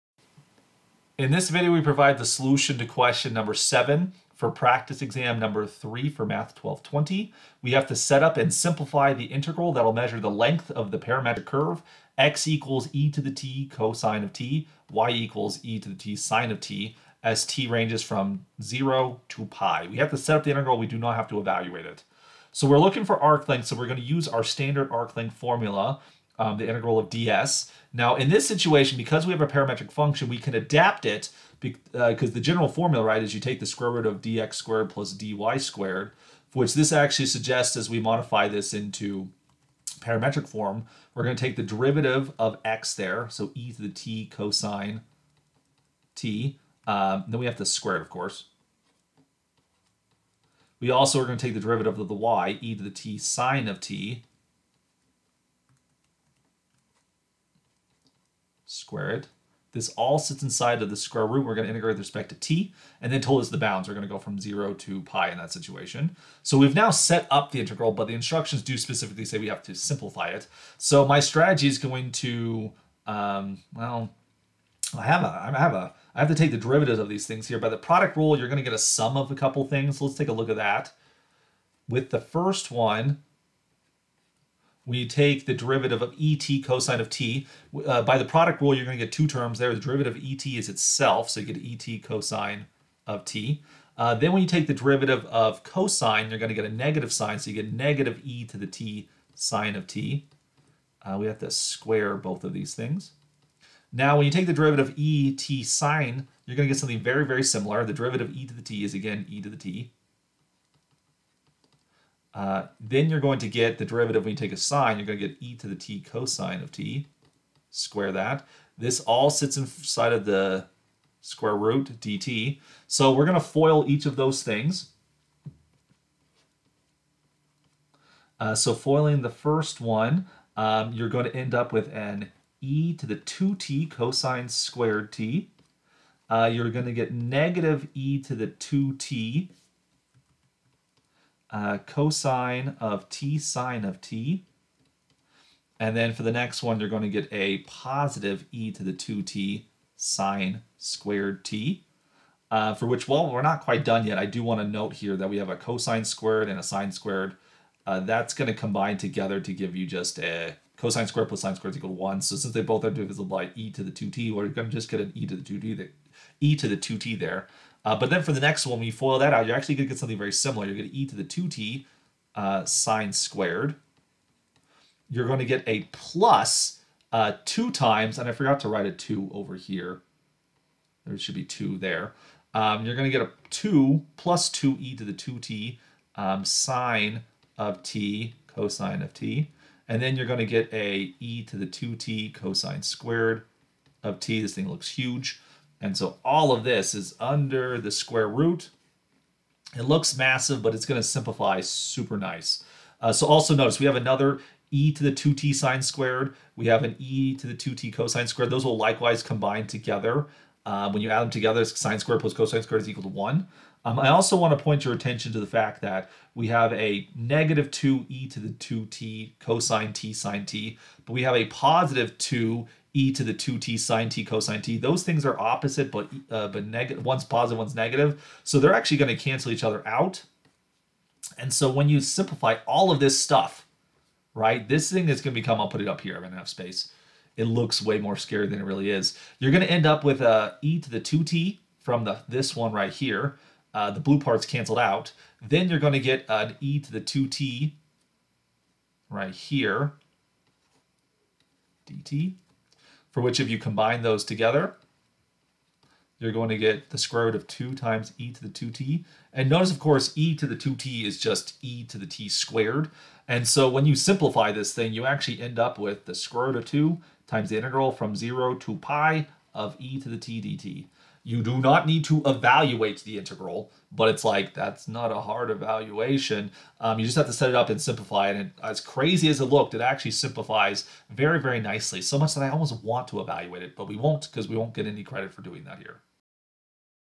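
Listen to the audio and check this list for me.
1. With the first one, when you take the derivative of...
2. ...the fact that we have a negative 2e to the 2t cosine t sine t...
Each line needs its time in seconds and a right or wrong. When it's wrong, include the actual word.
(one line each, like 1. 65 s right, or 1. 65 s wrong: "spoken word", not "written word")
1. 81 s right
2. 215 s right.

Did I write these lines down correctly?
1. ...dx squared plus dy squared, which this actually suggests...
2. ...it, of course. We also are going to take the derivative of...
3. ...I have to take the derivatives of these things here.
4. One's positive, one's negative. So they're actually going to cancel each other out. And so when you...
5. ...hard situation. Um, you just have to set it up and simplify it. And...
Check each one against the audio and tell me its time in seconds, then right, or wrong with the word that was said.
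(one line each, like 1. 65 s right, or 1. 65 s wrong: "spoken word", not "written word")
1. 34 s right
2. 47 s right
3. 76 s right
4. 227 s right
5. 275 s wrong: "evaluation", not "situation".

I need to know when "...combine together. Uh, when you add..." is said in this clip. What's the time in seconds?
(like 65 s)
209 s.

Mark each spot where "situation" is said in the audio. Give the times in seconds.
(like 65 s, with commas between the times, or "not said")
28 s, 65 s.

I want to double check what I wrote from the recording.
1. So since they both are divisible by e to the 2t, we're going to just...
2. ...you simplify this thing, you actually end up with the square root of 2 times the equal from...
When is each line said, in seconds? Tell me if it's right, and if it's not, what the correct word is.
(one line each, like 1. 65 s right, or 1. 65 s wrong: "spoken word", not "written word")
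1. 162 s right
2. 263 s wrong: "integral", not "equal".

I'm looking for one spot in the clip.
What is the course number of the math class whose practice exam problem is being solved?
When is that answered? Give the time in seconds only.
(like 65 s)
6 s.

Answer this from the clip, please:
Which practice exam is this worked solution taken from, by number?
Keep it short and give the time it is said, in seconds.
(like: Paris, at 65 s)
3, at 4 s.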